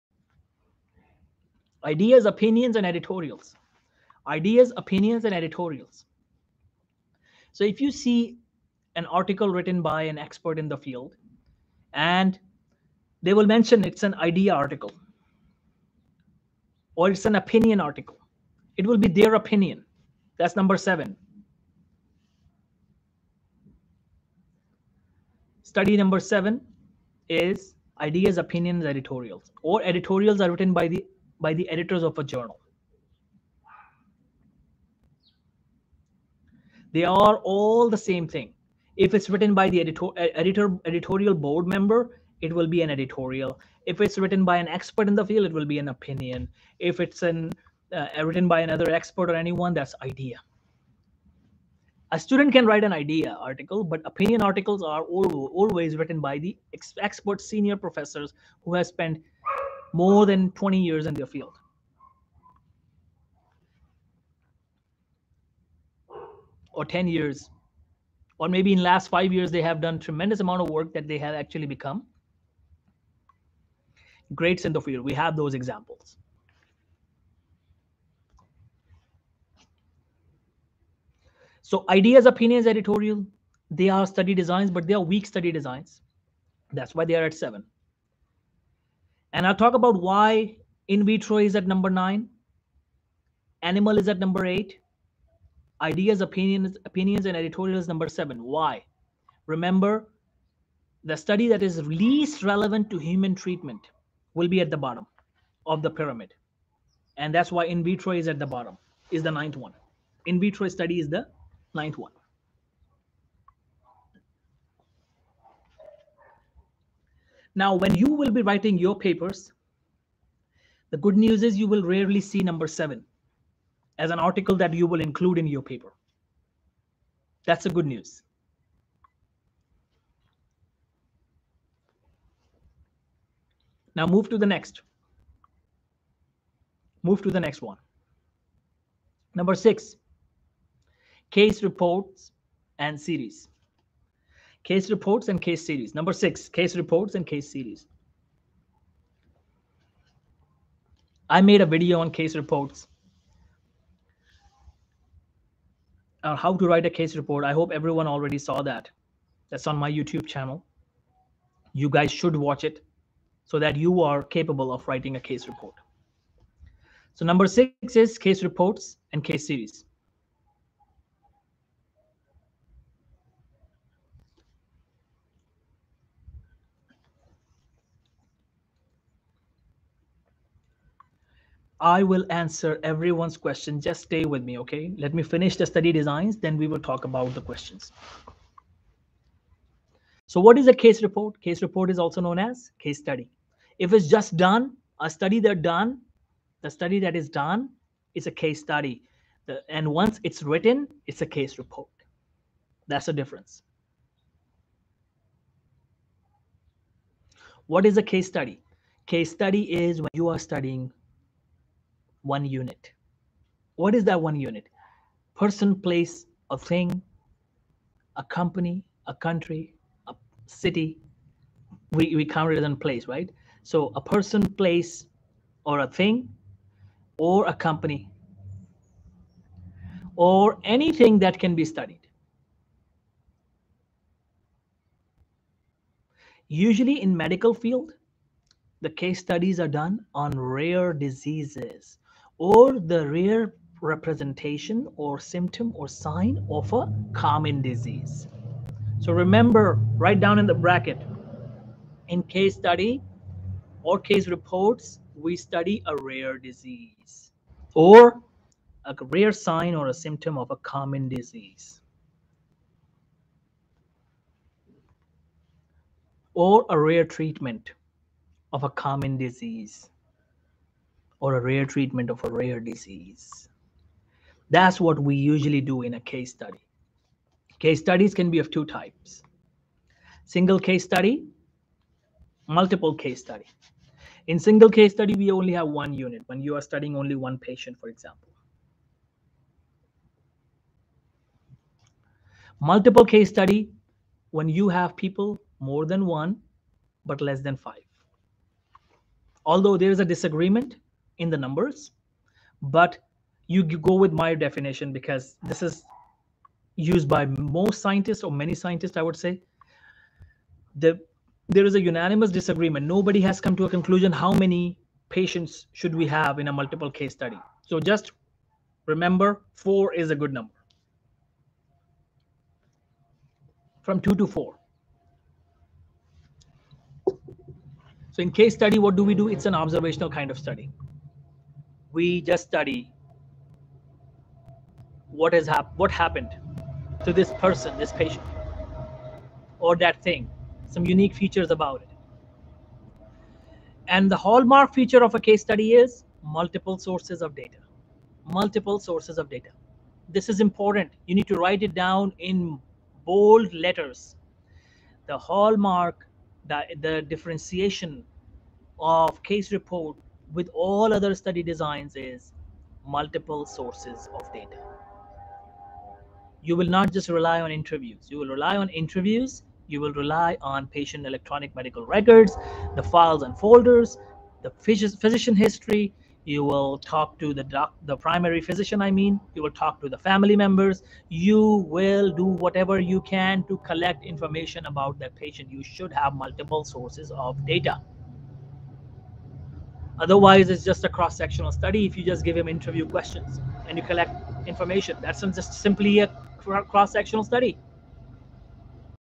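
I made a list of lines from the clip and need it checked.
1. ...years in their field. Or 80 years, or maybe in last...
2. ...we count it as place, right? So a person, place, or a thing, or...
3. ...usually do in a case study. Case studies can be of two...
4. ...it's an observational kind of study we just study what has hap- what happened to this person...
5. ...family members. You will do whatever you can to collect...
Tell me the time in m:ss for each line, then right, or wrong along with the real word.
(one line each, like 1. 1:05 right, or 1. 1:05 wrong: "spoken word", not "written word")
1. 1:00 wrong: "10", not "80"
2. 3:42 right
3. 4:35 right
4. 5:29 right
5. 6:19 right.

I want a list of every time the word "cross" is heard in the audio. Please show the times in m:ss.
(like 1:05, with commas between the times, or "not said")
6:30, 6:36.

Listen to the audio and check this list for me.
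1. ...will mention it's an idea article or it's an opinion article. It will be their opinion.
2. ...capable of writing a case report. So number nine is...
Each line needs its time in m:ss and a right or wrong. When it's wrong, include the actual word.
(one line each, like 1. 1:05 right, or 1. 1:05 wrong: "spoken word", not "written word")
1. 0:13 right
2. 2:44 wrong: "six", not "nine".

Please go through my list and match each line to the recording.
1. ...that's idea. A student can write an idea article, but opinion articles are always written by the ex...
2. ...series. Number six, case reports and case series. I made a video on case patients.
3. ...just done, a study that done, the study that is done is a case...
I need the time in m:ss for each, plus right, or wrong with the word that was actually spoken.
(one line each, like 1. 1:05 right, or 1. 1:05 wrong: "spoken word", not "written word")
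1. 0:49 right
2. 2:25 wrong: "reports", not "patients"
3. 3:14 right.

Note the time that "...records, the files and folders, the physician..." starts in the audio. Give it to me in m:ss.
6:11.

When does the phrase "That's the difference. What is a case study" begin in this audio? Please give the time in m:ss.
3:22.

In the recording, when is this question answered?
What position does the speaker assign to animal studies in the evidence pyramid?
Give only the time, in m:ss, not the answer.
1:34.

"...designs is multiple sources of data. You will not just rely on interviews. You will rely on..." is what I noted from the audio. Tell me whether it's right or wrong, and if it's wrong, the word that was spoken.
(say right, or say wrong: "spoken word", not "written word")
right.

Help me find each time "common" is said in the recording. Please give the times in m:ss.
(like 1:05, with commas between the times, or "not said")
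4:07, 4:20, 4:28.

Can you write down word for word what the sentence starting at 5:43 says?
And the hallmark feature of a case study is multiple sources of data.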